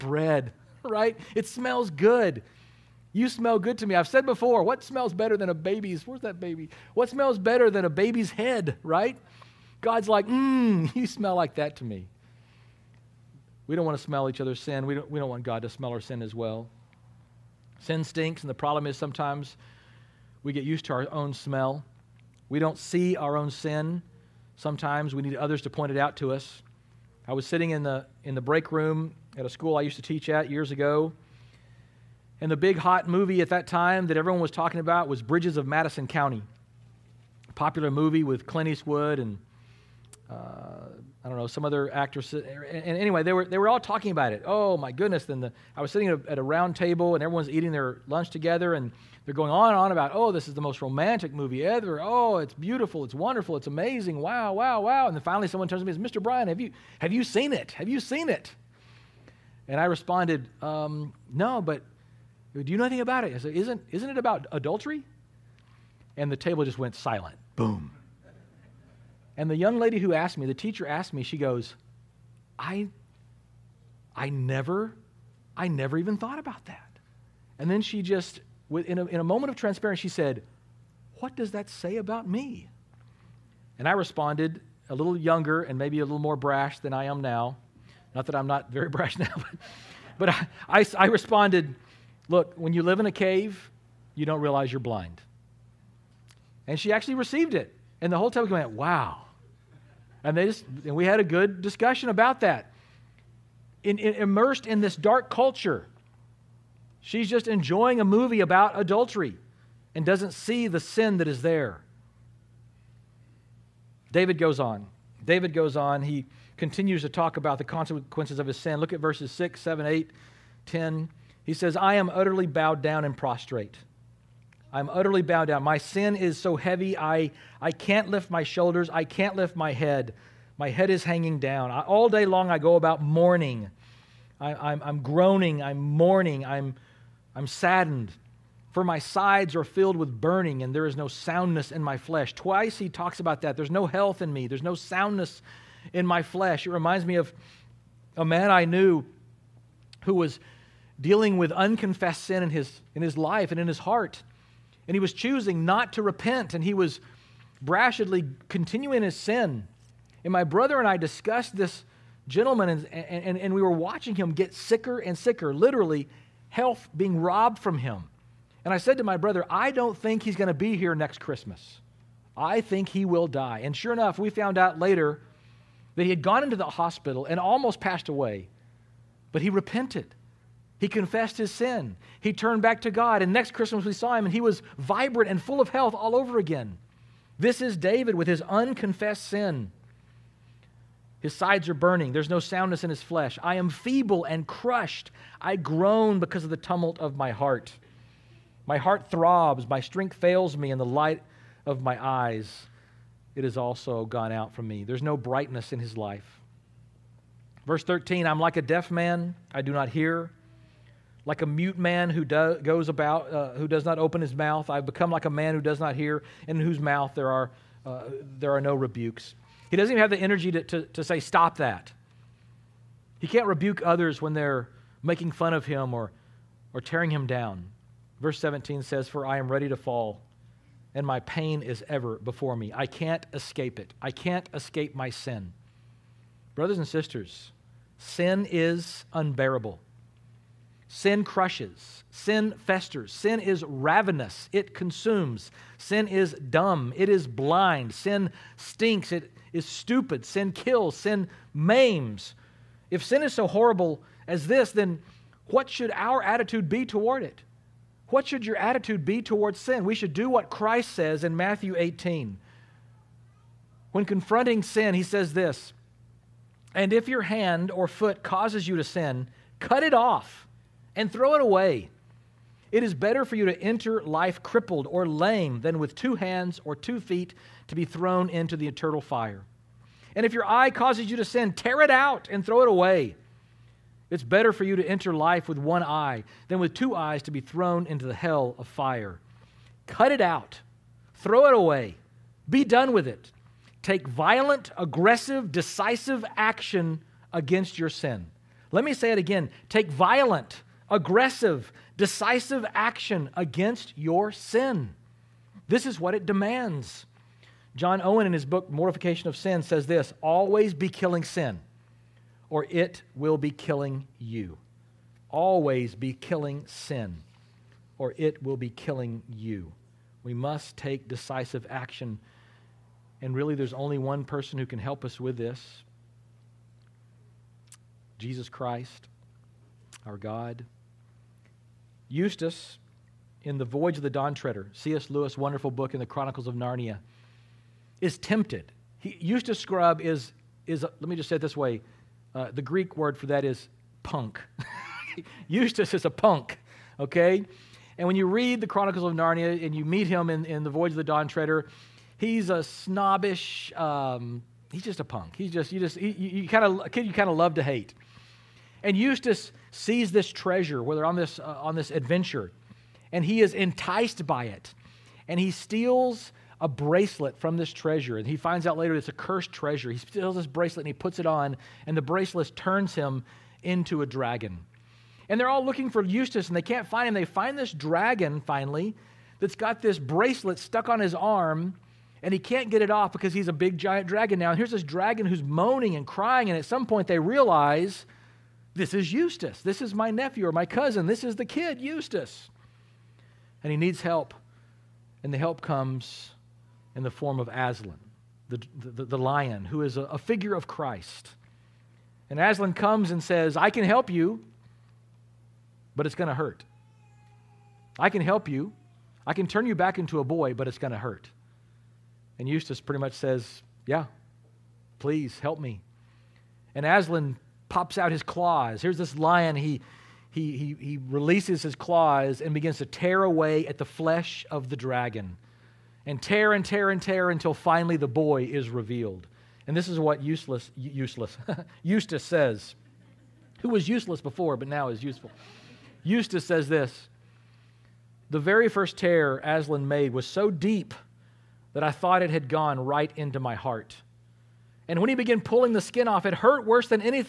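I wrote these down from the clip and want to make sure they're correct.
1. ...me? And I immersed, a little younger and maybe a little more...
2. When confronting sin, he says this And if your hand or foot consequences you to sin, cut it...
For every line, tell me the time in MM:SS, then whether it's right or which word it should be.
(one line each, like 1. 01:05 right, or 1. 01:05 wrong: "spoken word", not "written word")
1. 01:22 wrong: "responded", not "immersed"
2. 04:23 wrong: "causes", not "consequences".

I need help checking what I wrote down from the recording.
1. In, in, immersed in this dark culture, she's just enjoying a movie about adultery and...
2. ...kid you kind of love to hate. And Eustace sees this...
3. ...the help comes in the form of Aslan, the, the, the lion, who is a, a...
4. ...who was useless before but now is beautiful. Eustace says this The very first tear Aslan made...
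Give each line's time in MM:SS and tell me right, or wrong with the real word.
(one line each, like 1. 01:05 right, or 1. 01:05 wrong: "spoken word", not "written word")
1. 01:43 right
2. 05:56 right
3. 06:35 right
4. 07:13 wrong: "useful", not "beautiful".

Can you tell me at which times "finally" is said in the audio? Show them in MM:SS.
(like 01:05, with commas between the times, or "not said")
00:55, 06:18, 07:07.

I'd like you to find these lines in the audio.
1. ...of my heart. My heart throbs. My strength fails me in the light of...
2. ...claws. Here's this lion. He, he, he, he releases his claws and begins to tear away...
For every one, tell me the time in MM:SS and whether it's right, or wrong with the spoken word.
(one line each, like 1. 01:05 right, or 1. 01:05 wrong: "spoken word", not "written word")
1. 03:16 right
2. 06:58 right.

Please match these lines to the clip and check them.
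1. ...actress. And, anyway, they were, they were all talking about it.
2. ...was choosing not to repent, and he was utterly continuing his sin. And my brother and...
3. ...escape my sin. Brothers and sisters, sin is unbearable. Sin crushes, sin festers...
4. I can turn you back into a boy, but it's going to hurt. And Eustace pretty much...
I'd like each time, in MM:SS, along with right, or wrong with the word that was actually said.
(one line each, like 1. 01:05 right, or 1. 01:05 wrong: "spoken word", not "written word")
1. 00:41 right
2. 02:34 wrong: "brashly", not "utterly"
3. 03:54 right
4. 06:49 right.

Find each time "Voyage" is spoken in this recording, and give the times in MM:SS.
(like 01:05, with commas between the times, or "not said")
05:33, 05:50.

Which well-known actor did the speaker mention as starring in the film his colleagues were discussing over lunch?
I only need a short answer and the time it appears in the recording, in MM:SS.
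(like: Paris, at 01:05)
Clint Eastwood, at 00:38.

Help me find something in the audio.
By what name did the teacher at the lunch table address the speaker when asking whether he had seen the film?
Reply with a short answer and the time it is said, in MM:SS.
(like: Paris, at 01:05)
Mr. Bryan, at 00:56.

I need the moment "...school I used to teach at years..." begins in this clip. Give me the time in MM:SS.
00:29.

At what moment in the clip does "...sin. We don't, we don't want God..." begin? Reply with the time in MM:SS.
00:14.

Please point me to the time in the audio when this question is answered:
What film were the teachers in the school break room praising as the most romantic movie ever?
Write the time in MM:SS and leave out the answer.
00:35.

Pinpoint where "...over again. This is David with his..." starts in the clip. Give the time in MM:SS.
03:06.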